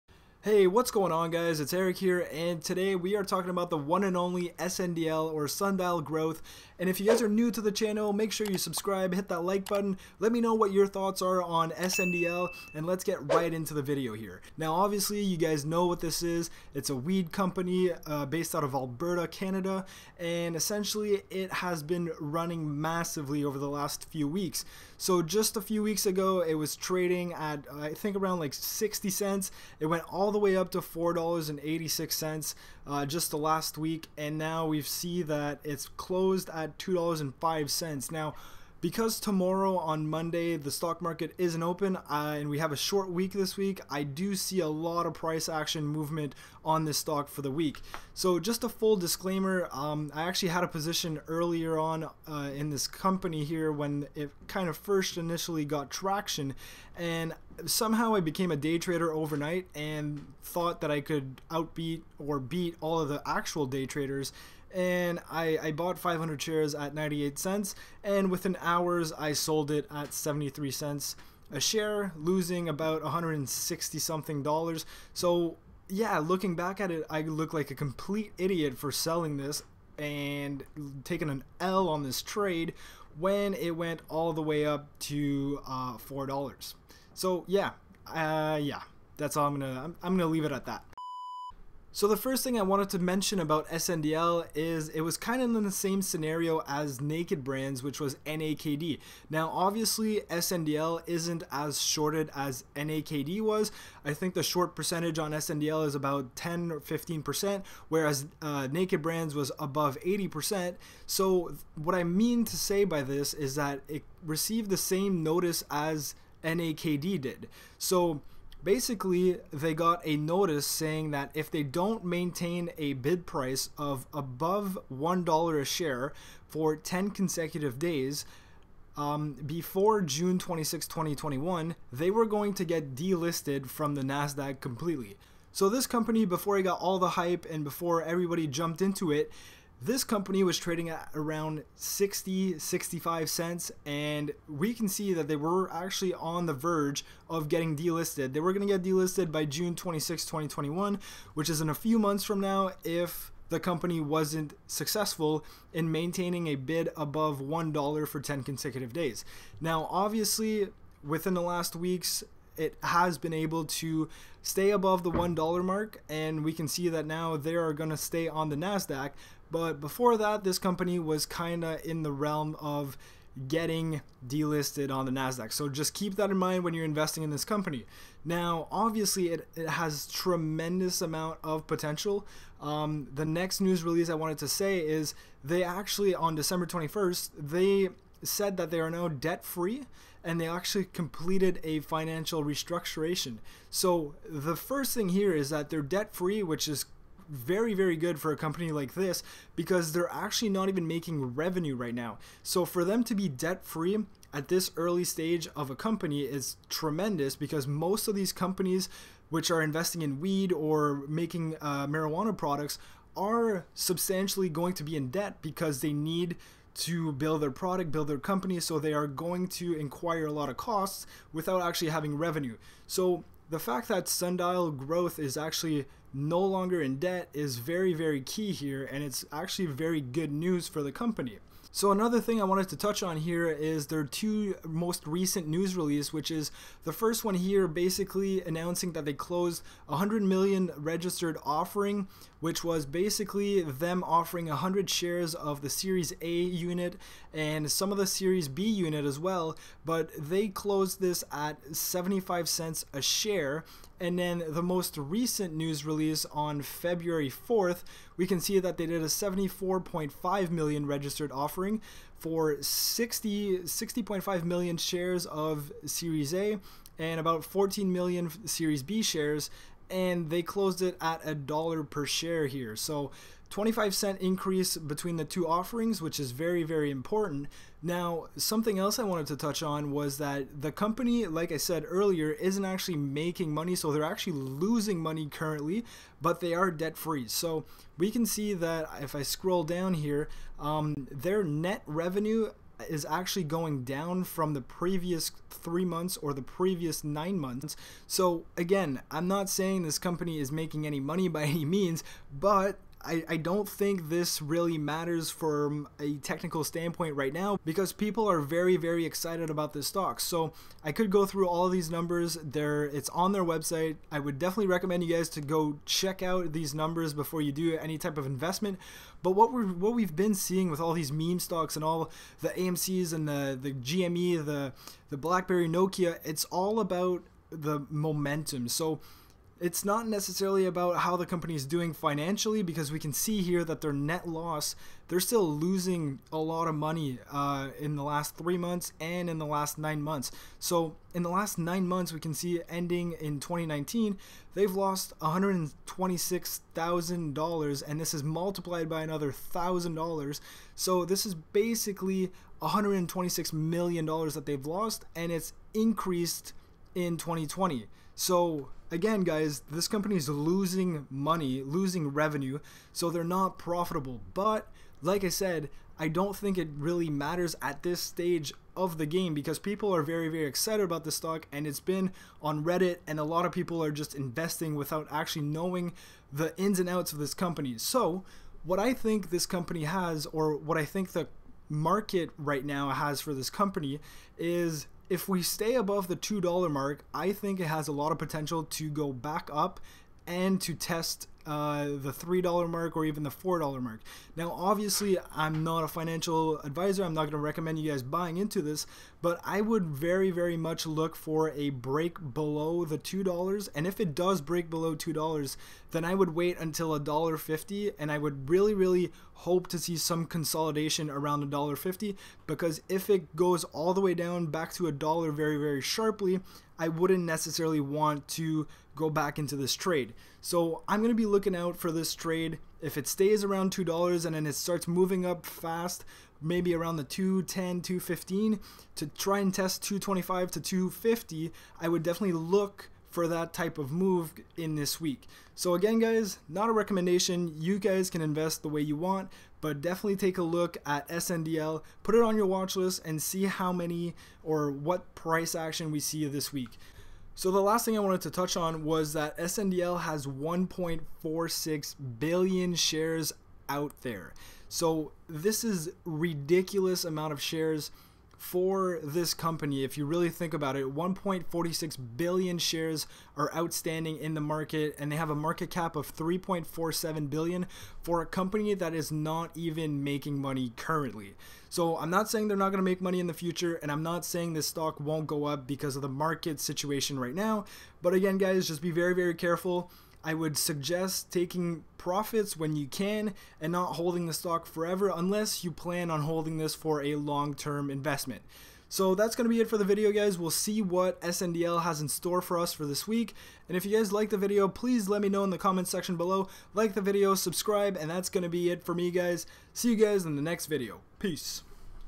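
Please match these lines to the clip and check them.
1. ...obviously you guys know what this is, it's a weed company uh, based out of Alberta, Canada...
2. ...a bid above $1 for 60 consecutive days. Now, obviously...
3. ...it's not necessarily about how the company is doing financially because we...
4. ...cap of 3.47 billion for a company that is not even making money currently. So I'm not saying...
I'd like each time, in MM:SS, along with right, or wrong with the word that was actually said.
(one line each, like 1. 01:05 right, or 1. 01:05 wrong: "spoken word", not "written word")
1. 00:14 right
2. 02:36 wrong: "10", not "60"
3. 05:29 right
4. 07:45 right.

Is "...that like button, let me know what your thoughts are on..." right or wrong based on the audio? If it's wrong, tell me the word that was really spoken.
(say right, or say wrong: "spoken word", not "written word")
right.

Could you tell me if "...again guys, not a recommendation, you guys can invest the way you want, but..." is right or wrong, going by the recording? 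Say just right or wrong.
right.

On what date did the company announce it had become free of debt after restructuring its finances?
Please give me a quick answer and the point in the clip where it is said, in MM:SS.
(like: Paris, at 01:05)
December 21st, at 03:06.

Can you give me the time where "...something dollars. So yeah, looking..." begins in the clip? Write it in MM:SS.
01:13.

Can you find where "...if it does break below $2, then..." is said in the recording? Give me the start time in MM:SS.
06:43.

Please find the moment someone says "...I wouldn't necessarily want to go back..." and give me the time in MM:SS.
06:56.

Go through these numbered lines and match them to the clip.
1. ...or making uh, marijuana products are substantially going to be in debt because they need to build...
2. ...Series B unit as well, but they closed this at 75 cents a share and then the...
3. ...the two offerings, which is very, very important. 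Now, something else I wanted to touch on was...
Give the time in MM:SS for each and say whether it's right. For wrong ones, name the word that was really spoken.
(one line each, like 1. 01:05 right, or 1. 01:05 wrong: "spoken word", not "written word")
1. 03:30 right
2. 04:08 right
3. 04:35 right.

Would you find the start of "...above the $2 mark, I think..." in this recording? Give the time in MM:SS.
06:25.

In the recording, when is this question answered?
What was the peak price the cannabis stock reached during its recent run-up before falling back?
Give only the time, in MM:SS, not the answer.
00:30.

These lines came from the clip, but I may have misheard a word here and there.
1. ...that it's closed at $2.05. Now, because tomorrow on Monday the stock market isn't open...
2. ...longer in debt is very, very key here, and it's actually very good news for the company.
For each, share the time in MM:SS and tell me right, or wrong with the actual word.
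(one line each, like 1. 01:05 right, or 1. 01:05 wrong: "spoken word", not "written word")
1. 00:35 right
2. 03:46 right.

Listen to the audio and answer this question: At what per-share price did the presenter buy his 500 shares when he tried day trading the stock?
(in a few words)
98 cents.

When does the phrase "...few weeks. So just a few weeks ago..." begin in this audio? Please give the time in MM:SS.
00:24.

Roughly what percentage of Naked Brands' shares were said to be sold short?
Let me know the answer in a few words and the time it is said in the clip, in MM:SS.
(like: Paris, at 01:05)
above 80%, at 01:49.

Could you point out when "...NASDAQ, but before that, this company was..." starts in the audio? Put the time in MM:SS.
02:48.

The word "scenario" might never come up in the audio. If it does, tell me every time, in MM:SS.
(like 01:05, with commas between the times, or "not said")
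01:36.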